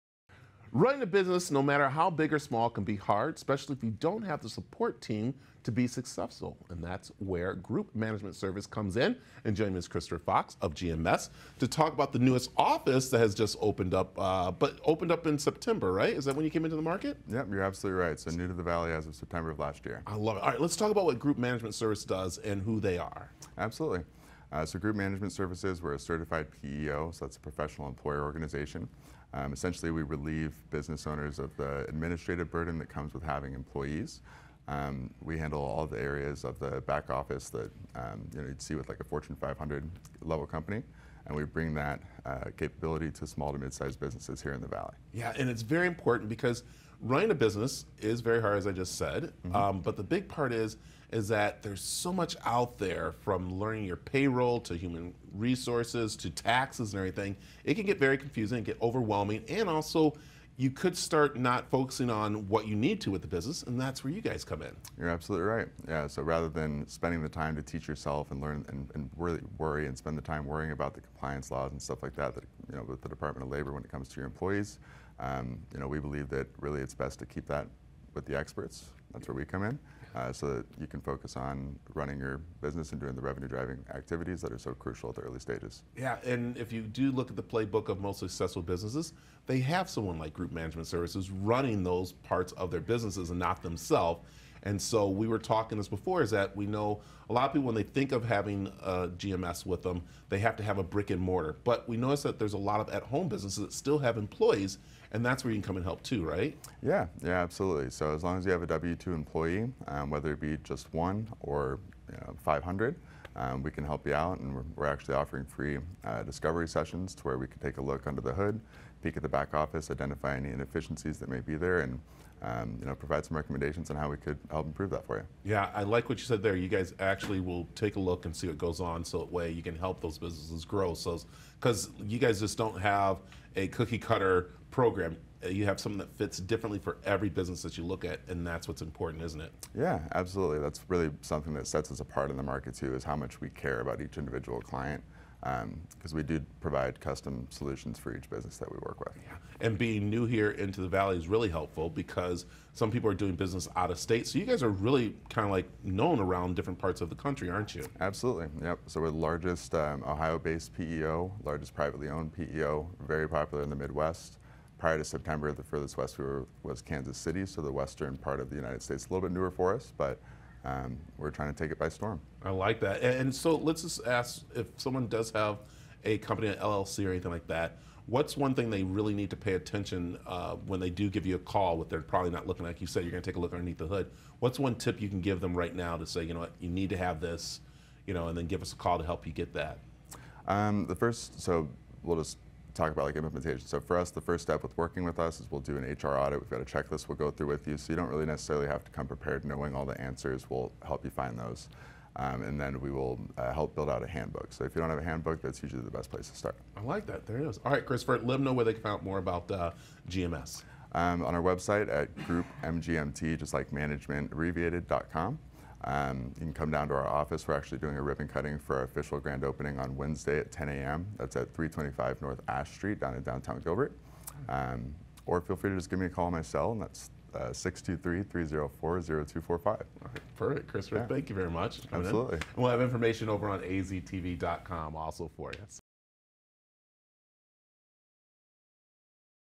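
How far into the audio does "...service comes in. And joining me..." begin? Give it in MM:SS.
00:08.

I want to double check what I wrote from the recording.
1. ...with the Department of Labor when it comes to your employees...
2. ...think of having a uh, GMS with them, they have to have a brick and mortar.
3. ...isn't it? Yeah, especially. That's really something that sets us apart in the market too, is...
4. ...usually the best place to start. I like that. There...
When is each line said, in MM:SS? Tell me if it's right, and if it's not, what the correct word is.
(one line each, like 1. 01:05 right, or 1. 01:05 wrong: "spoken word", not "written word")
1. 01:12 right
2. 01:37 right
3. 02:19 wrong: "absolutely", not "especially"
4. 03:25 right.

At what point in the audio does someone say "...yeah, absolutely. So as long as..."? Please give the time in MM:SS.
01:47.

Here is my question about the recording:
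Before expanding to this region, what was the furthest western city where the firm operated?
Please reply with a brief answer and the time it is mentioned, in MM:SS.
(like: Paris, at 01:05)
Kansas City, at 02:46.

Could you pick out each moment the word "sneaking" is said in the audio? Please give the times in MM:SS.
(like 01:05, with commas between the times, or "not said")
not said.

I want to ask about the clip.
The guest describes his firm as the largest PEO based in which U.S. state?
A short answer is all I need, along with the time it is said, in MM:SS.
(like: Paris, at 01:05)
Ohio, at 02:40.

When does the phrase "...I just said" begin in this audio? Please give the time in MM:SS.
00:48.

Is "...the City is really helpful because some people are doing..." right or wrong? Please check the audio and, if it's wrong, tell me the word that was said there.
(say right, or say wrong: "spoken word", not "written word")
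wrong: "Valley", not "City".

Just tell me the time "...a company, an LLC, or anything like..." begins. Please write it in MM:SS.
02:56.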